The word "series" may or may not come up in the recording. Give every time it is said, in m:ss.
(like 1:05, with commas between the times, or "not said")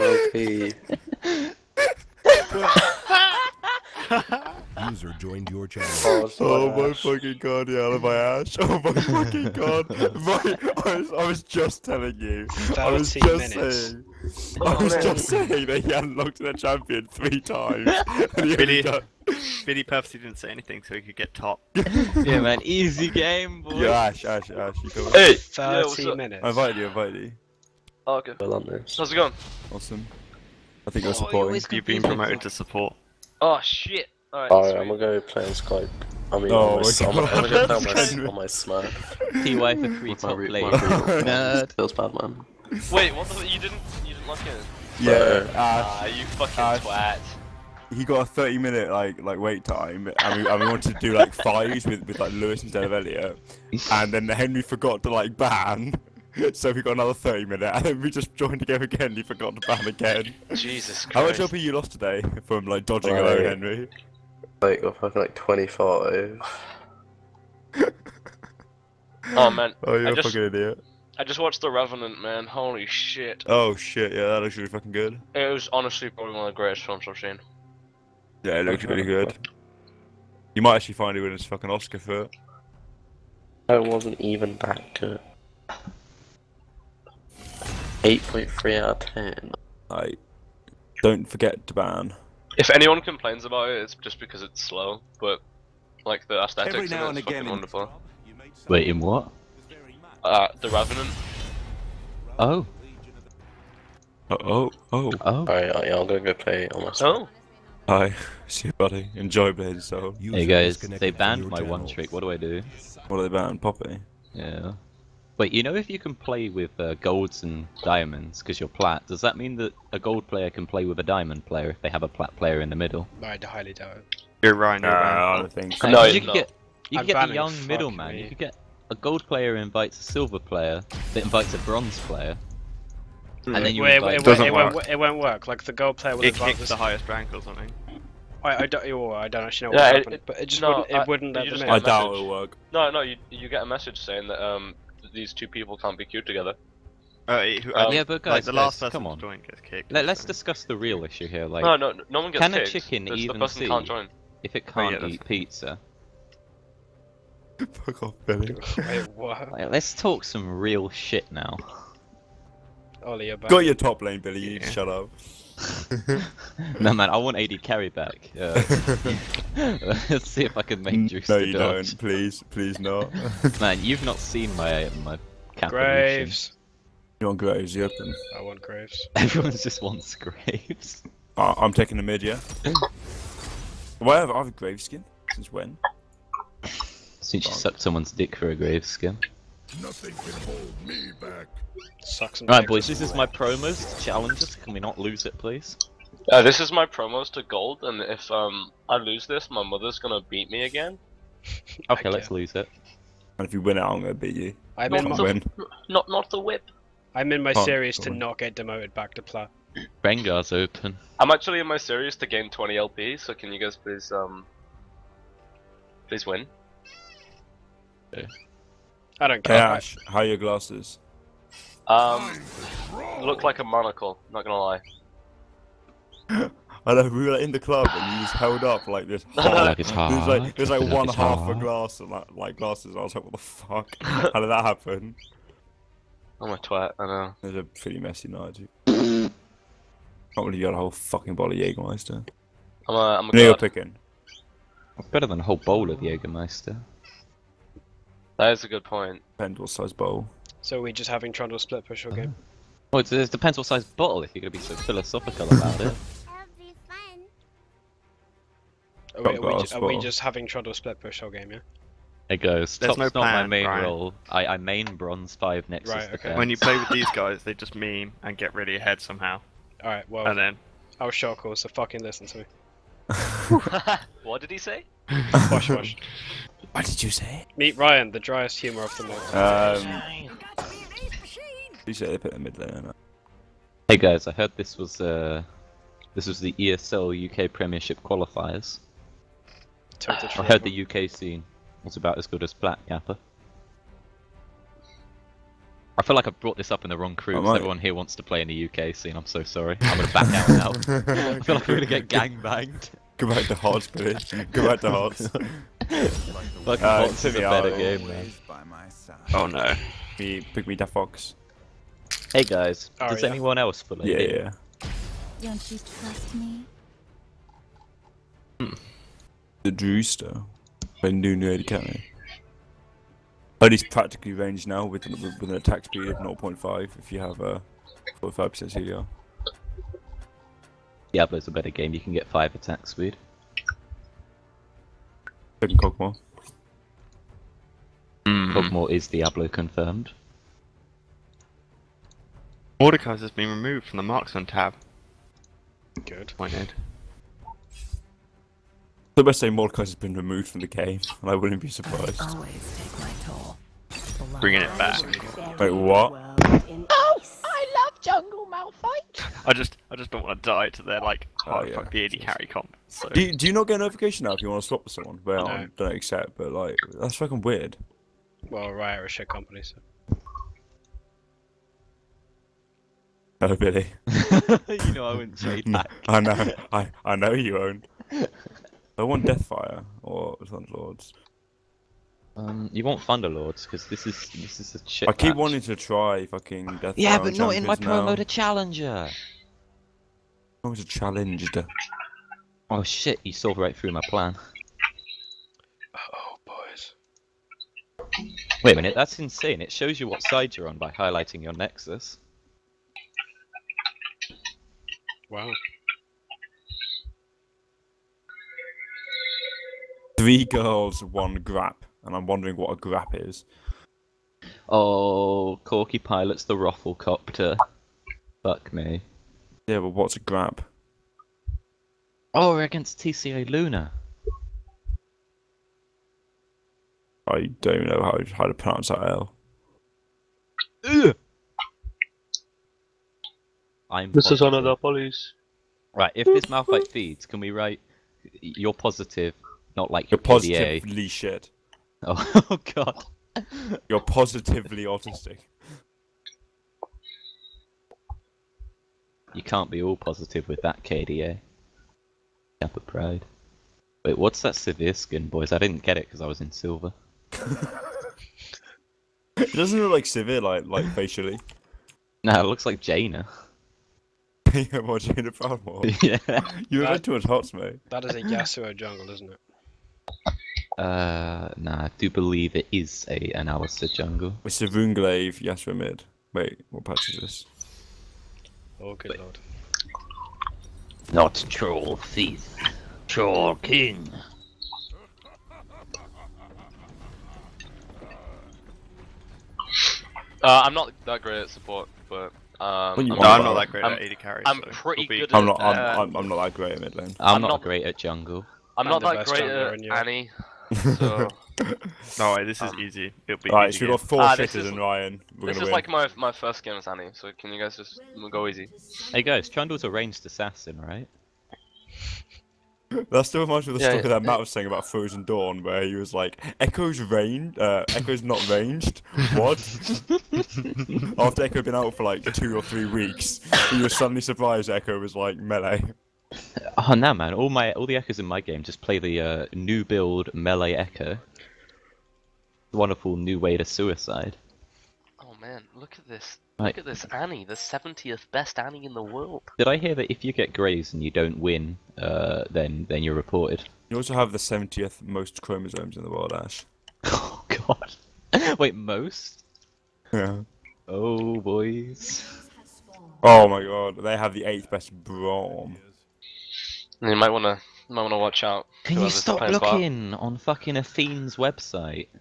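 3:27, 3:31.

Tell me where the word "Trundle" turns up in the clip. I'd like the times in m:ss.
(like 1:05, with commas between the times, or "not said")
4:11, 4:20, 8:29.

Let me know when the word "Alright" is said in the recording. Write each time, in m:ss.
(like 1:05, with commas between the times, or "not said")
0:34, 1:45, 4:29, 8:23.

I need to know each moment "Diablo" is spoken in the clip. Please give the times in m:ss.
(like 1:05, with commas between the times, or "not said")
5:31, 5:39.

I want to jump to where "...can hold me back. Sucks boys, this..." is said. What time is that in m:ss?
3:10.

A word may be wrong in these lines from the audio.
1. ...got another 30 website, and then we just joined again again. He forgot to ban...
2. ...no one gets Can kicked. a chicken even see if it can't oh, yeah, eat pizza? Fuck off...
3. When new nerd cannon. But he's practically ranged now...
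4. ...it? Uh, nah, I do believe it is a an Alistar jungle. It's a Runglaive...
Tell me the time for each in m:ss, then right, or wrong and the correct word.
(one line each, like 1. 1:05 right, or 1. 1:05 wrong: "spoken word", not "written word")
1. 0:56 wrong: "minute", not "website"
2. 2:32 right
3. 5:21 right
4. 7:49 right.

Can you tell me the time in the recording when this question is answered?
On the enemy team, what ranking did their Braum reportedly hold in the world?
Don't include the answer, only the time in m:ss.
9:14.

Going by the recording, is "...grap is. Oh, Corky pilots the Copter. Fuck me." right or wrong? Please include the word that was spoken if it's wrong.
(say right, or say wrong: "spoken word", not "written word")
right.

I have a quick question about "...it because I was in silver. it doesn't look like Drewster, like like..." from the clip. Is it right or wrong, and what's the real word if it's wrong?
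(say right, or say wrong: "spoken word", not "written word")
wrong: "Sivir", not "Drewster".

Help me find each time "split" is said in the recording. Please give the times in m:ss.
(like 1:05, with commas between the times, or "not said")
4:11, 4:20.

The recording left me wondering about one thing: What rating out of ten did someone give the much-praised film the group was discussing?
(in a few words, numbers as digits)
8.3.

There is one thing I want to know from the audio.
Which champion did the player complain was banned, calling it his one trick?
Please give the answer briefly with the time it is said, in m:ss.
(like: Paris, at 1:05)
Poppy, at 1:53.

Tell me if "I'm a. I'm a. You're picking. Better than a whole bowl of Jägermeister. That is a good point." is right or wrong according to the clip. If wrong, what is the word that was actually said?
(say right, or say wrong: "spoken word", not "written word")
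right.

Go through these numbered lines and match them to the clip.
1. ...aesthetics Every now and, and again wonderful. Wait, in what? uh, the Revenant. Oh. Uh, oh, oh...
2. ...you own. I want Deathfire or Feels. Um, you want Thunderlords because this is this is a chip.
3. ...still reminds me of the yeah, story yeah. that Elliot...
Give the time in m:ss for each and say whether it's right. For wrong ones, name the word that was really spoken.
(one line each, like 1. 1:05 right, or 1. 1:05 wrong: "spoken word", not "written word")
1. 1:36 right
2. 6:17 wrong: "Lords", not "Feels"
3. 8:33 wrong: "Matt", not "Elliot".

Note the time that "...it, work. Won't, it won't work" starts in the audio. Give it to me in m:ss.
2:14.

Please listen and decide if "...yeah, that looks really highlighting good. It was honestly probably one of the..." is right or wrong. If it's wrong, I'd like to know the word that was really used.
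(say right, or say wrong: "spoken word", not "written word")
wrong: "fucking", not "highlighting".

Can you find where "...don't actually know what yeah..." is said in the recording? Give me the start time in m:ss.
2:19.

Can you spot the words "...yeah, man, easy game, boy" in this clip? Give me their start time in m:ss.
0:22.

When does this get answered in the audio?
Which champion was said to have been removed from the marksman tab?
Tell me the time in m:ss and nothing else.
5:42.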